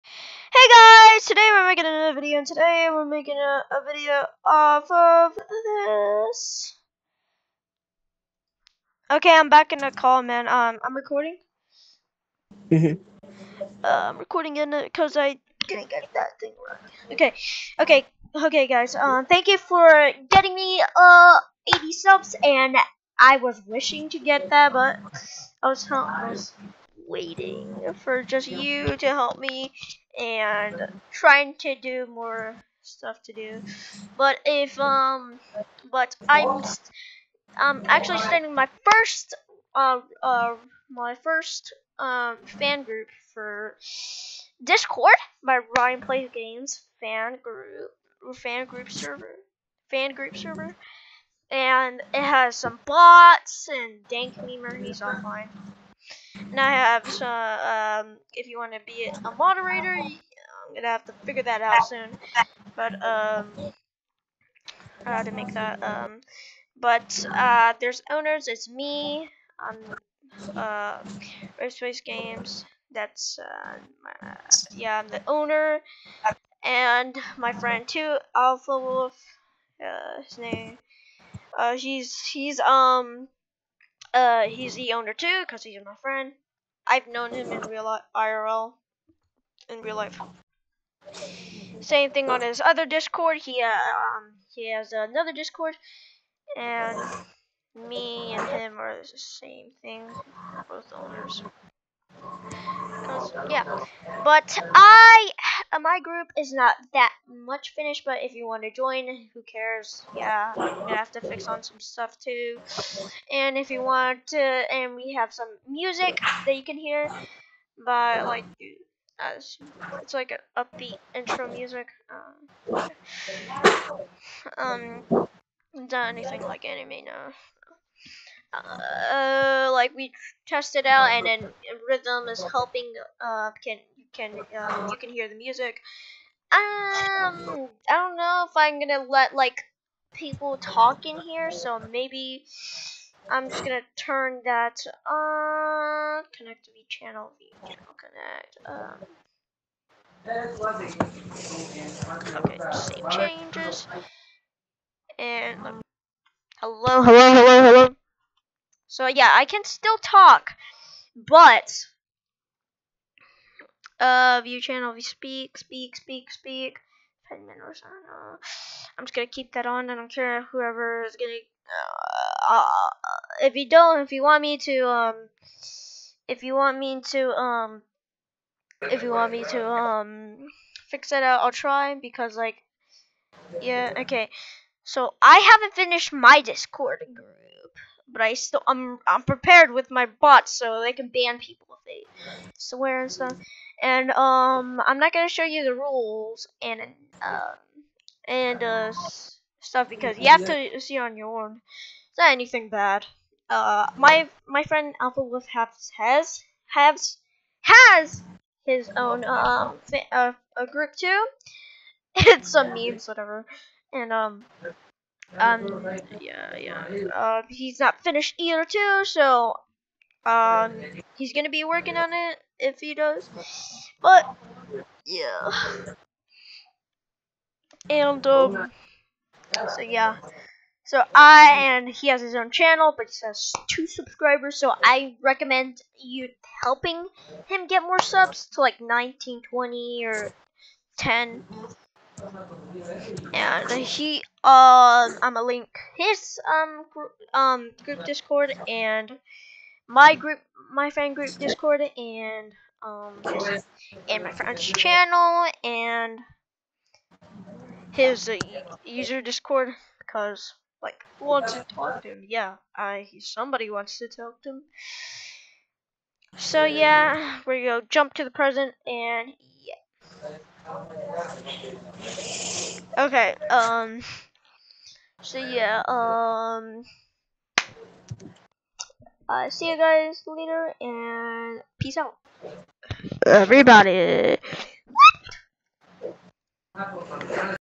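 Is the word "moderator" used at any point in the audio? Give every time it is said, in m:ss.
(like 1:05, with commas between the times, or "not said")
0:59.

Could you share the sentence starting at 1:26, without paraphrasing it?
I've known him in real life, IRL, in real life.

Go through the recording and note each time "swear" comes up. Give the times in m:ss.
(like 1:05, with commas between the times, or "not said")
3:12.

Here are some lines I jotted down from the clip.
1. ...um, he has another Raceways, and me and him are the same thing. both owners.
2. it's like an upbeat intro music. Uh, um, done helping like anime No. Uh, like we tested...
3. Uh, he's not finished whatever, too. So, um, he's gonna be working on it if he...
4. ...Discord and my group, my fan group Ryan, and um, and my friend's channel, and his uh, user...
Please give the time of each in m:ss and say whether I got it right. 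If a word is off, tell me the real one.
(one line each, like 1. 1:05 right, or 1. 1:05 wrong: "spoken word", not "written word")
1. 1:33 wrong: "Discord", not "Raceways"
2. 2:00 wrong: "anything", not "helping"
3. 3:37 wrong: "either", not "whatever"
4. 4:08 wrong: "Discord", not "Ryan".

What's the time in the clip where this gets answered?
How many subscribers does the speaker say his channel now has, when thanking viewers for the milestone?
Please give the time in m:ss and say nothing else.
0:21.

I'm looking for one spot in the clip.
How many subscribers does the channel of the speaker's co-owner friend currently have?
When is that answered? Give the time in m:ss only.
3:53.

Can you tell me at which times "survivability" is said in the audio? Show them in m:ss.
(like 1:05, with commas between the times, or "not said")
not said.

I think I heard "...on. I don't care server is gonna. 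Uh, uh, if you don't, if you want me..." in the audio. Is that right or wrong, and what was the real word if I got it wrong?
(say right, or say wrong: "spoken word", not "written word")
wrong: "whoever", not "server".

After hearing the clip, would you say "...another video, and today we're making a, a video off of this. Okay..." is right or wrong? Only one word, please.
right.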